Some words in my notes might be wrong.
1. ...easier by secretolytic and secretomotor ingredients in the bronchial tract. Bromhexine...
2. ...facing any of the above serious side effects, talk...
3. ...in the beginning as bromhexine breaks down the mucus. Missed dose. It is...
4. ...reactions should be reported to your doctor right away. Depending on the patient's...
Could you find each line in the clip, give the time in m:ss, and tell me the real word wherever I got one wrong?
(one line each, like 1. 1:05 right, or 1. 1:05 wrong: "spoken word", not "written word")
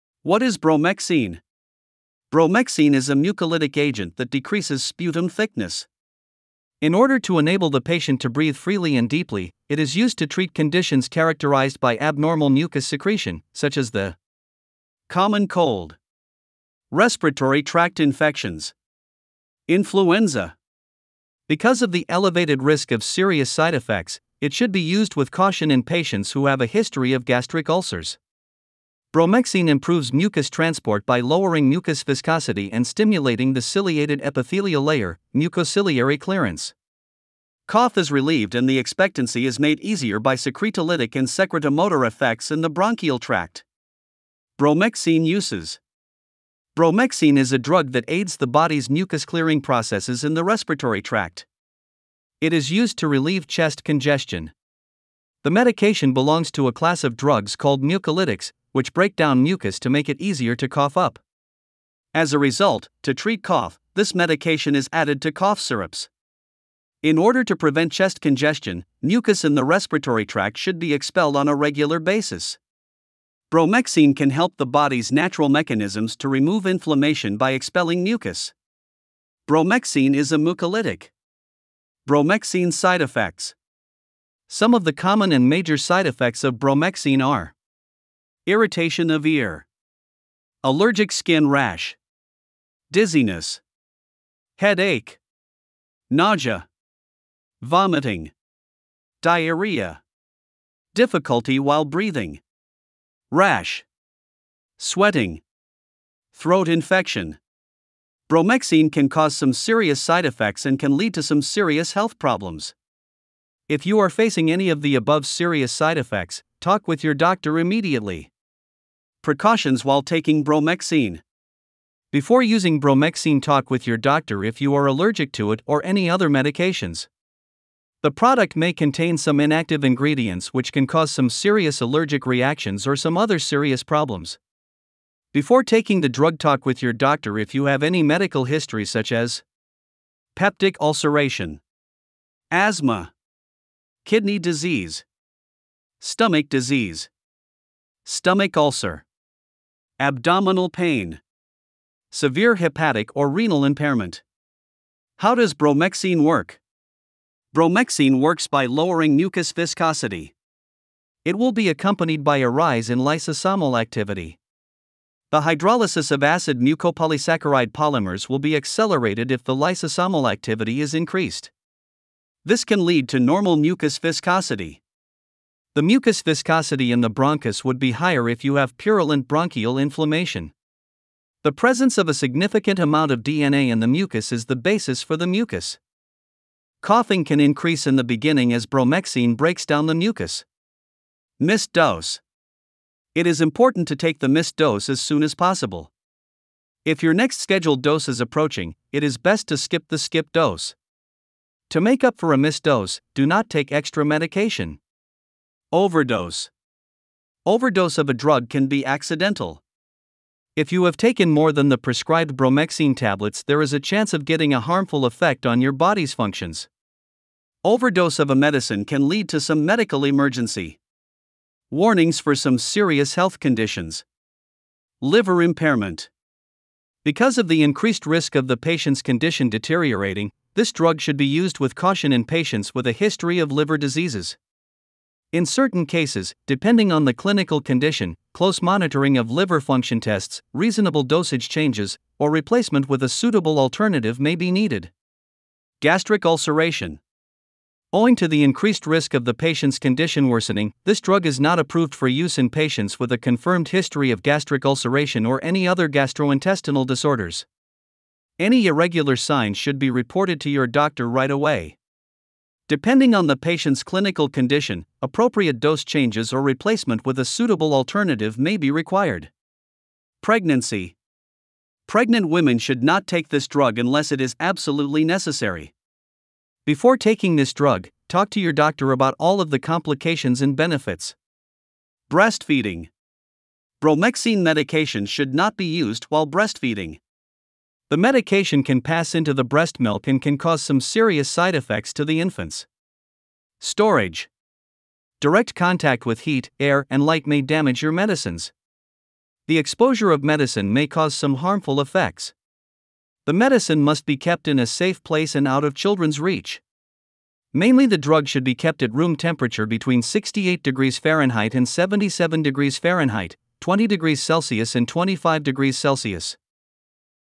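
1. 0:39 wrong: "effects", not "ingredients"
2. 1:54 right
3. 3:07 right
4. 4:19 wrong: "signs", not "reactions".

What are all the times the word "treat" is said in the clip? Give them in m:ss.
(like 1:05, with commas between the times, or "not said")
0:10, 1:03.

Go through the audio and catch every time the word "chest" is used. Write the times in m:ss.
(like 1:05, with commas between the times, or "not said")
0:53, 1:07.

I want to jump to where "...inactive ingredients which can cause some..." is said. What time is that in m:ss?
2:09.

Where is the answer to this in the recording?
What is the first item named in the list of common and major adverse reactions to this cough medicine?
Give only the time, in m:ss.
1:28.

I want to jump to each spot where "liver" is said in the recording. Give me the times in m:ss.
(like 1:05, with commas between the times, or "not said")
3:45, 3:53, 3:59.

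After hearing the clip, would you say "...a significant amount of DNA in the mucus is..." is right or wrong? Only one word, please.
right.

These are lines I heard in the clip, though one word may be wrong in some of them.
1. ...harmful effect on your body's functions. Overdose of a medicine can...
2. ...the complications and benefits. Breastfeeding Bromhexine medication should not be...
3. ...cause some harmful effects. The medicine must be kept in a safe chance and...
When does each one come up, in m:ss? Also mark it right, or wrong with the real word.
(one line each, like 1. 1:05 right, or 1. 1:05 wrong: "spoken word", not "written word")
1. 3:34 right
2. 4:39 right
3. 5:00 wrong: "place", not "chance".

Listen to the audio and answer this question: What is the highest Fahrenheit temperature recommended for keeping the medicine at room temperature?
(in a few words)
77 degrees Fahrenheit.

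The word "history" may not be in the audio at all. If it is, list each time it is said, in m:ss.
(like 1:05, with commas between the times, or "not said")
0:26, 2:18, 3:52, 4:13.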